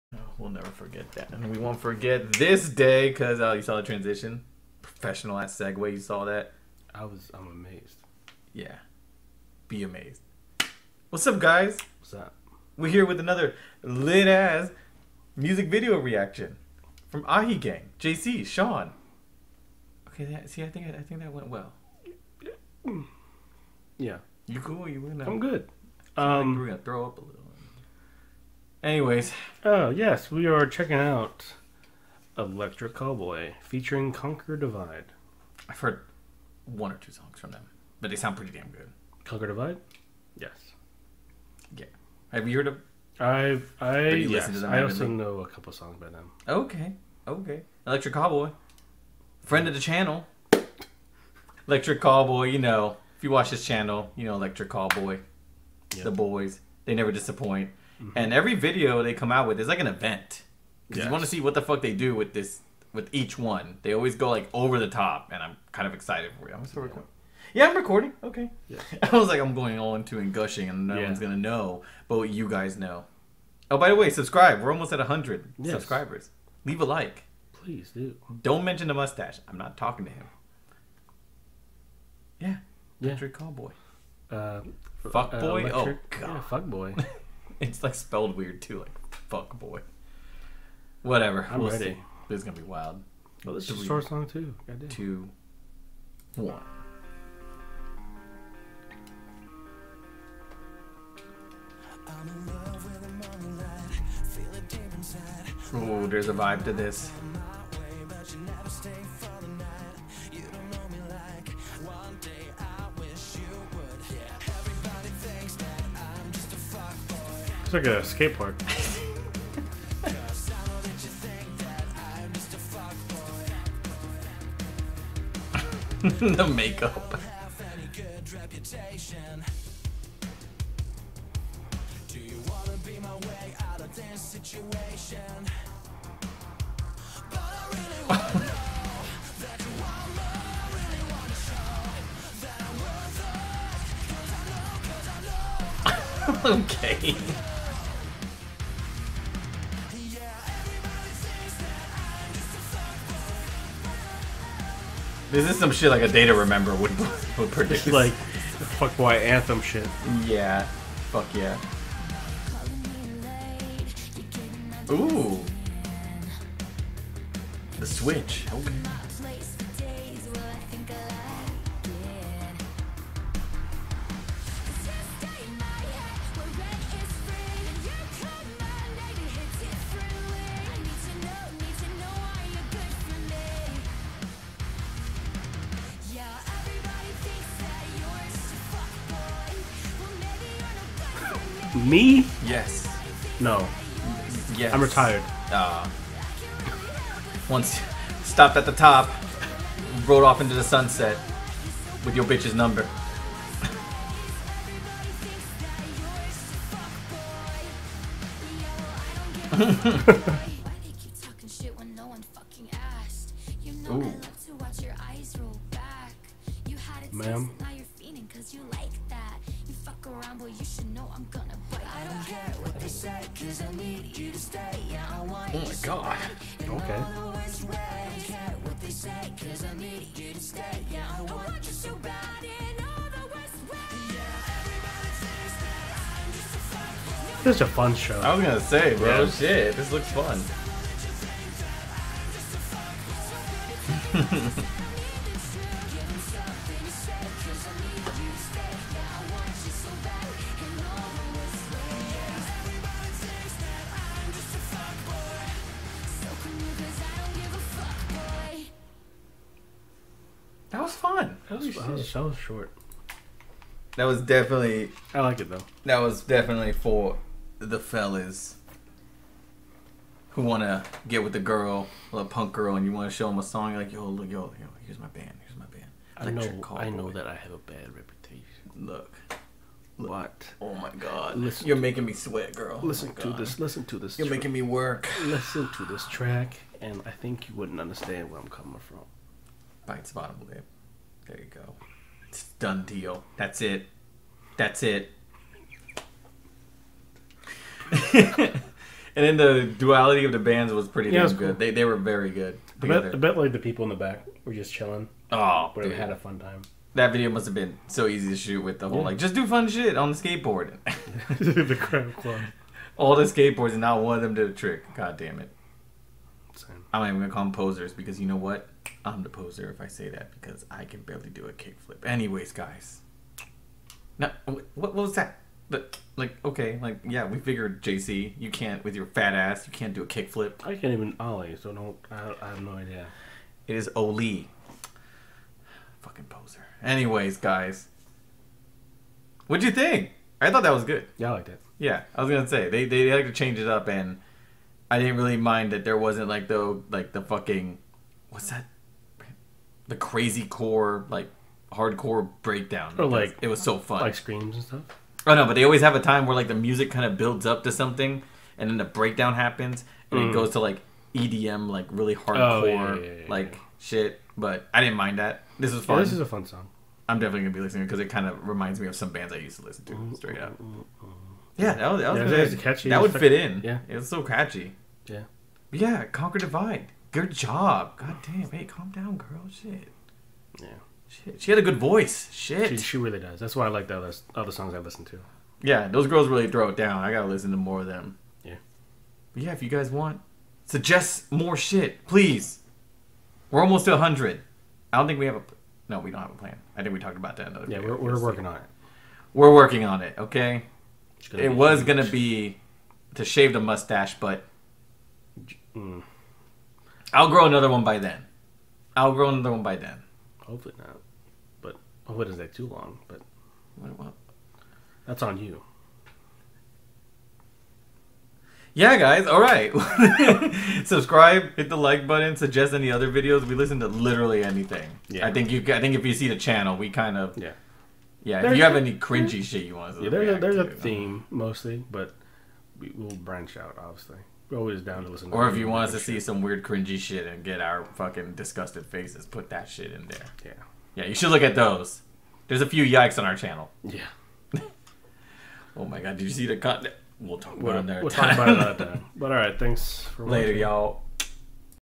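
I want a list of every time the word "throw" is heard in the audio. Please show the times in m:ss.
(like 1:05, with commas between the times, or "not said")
0:26, 6:26.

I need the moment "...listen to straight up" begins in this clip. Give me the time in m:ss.
6:09.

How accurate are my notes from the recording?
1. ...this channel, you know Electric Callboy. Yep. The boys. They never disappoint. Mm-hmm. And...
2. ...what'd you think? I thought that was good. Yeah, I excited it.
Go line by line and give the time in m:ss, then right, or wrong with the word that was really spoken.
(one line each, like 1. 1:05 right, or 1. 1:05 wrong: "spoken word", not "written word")
1. 0:53 right
2. 5:39 wrong: "liked", not "excited".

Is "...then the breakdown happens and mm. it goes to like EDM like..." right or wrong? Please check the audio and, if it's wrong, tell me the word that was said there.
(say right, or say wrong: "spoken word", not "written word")
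right.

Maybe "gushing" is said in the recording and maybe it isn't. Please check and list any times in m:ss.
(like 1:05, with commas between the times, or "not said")
1:10.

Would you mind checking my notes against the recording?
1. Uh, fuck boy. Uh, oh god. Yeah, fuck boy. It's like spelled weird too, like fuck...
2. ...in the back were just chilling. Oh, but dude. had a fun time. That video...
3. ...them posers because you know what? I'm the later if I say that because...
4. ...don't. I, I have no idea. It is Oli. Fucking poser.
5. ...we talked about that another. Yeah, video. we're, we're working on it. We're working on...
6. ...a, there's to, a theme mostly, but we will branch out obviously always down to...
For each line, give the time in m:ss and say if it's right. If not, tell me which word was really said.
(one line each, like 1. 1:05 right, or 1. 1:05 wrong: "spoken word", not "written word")
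1. 1:24 right
2. 5:03 right
3. 5:17 wrong: "poser", not "later"
4. 5:31 right
5. 6:36 right
6. 7:10 right.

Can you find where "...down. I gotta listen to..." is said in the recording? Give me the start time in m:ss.
6:26.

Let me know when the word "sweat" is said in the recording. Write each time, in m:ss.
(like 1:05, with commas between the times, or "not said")
4:42.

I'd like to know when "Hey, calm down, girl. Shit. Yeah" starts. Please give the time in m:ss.
6:18.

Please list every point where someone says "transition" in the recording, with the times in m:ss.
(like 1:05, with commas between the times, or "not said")
0:03.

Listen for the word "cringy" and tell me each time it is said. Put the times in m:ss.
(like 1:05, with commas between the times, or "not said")
7:08, 7:16.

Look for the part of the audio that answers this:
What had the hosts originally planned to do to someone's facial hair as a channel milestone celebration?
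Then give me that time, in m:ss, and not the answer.
6:43.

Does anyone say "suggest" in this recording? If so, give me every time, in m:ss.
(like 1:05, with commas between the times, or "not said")
6:30, 7:02.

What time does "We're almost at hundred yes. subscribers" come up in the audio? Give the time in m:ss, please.
1:14.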